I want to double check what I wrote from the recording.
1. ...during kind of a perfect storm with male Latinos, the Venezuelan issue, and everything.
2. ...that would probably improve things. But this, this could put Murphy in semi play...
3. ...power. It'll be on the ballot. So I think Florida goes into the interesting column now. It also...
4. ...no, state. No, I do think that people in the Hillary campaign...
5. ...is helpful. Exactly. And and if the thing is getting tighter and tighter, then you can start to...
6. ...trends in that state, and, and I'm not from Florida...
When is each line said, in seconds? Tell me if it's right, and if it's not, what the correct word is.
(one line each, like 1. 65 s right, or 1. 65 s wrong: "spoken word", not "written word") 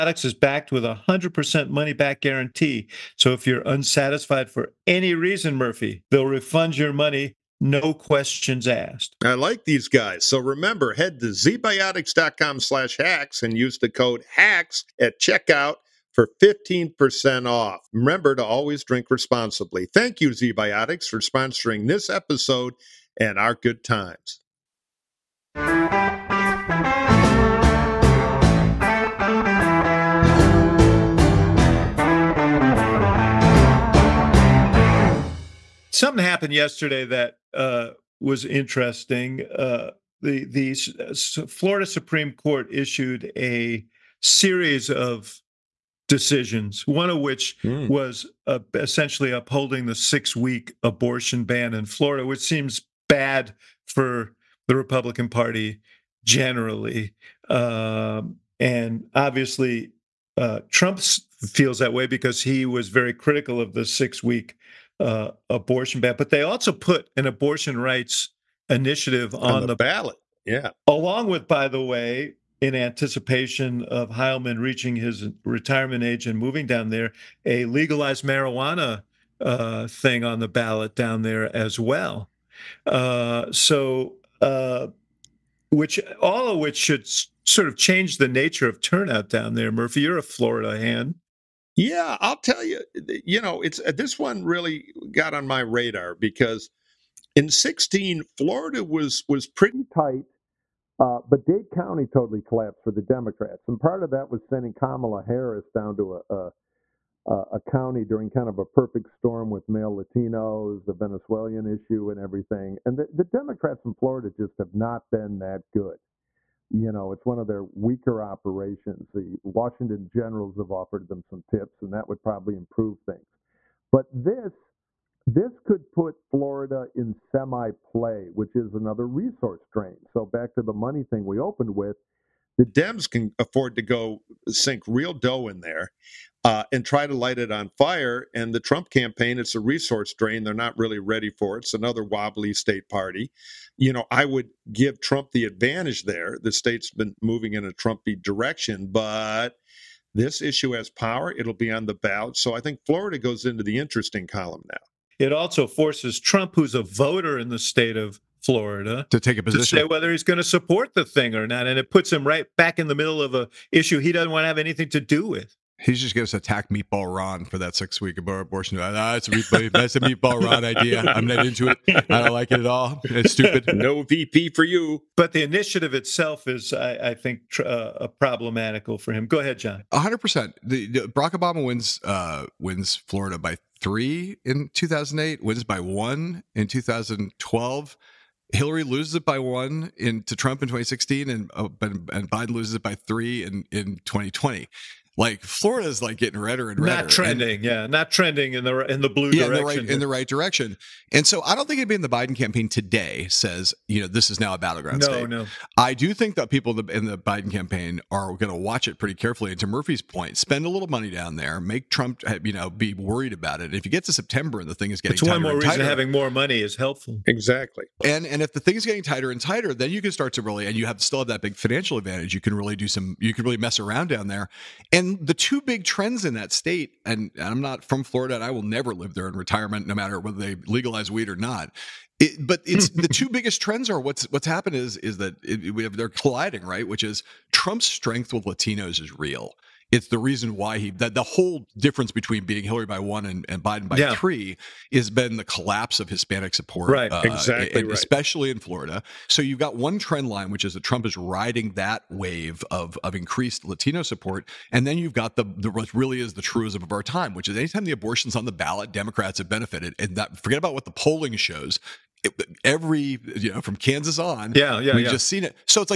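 1. 108 s right
2. 121 s wrong: "Florida", not "Murphy"
3. 150 s right
4. 205 s wrong: "Biden", not "Hillary"
5. 216 s right
6. 225 s right.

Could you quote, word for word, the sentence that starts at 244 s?
three has been the collapse of Hispanic support, right?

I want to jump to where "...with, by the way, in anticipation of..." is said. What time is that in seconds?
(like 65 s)
71 s.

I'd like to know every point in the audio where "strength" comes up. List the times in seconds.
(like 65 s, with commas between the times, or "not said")
237 s.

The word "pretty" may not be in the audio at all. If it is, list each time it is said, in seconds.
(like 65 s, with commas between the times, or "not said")
99 s, 208 s.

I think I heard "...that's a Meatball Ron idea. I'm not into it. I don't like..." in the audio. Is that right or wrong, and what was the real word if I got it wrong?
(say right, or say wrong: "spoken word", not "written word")
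right.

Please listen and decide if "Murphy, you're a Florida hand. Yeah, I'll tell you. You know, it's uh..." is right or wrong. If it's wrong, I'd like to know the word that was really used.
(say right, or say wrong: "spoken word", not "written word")
right.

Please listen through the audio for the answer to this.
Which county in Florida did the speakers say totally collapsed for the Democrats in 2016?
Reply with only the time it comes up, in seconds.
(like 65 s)
101 s.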